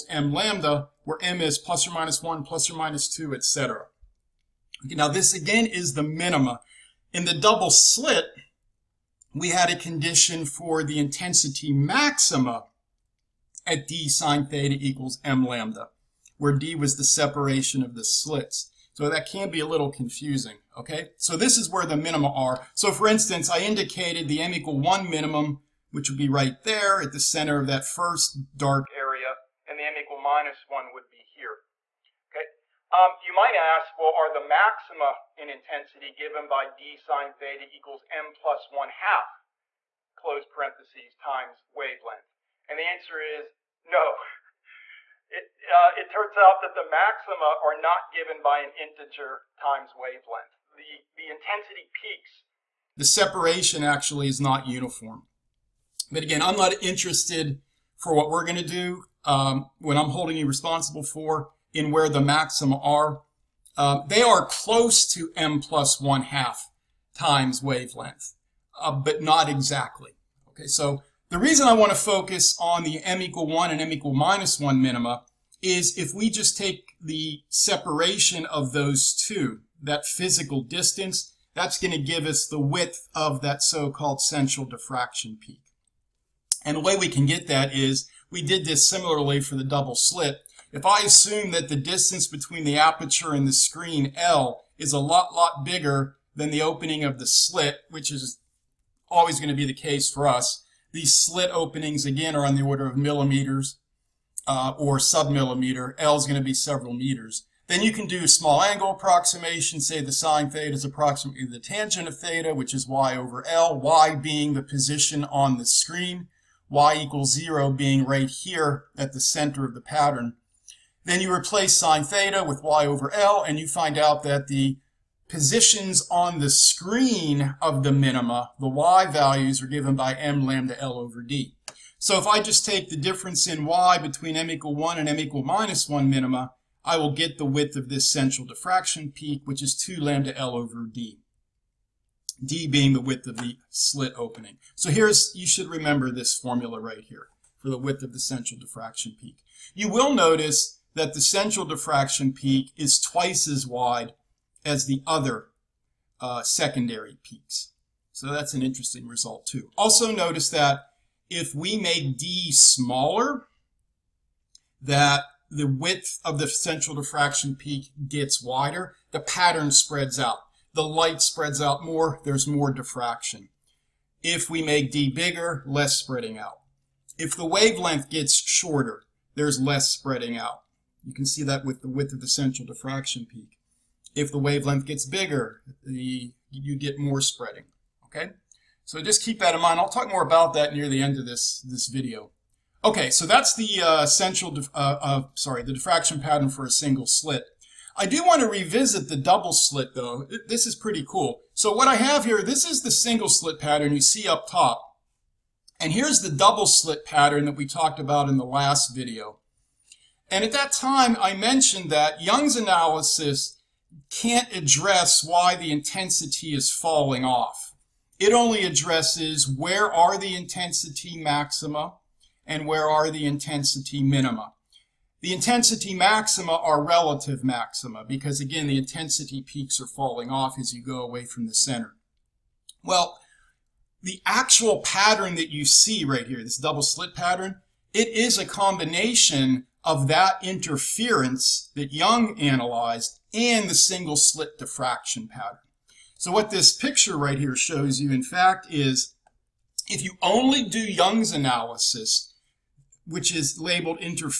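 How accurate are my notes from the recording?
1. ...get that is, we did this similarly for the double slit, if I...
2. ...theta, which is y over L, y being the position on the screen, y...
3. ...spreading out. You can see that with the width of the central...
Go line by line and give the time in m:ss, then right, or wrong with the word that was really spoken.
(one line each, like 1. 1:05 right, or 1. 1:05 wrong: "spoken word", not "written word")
1. 1:27 right
2. 1:52 right
3. 2:59 right.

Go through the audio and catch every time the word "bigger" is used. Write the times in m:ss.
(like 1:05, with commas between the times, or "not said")
1:35, 2:55, 3:05.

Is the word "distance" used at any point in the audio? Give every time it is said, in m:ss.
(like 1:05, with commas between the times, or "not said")
1:20, 1:31.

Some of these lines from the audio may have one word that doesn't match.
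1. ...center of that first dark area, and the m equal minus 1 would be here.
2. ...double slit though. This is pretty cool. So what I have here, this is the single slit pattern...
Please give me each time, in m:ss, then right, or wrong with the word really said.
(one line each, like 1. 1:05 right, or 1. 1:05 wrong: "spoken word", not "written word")
1. 0:27 right
2. 3:19 right.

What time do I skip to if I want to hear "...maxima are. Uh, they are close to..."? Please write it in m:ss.
1:02.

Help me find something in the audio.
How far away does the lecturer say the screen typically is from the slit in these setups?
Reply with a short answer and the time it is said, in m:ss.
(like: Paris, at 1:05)
several meters, at 1:46.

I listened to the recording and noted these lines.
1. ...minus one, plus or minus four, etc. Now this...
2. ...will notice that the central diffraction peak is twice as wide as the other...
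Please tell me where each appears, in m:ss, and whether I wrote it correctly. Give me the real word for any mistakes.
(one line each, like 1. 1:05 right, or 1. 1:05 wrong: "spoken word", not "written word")
1. 0:01 wrong: "two", not "four"
2. 2:29 right.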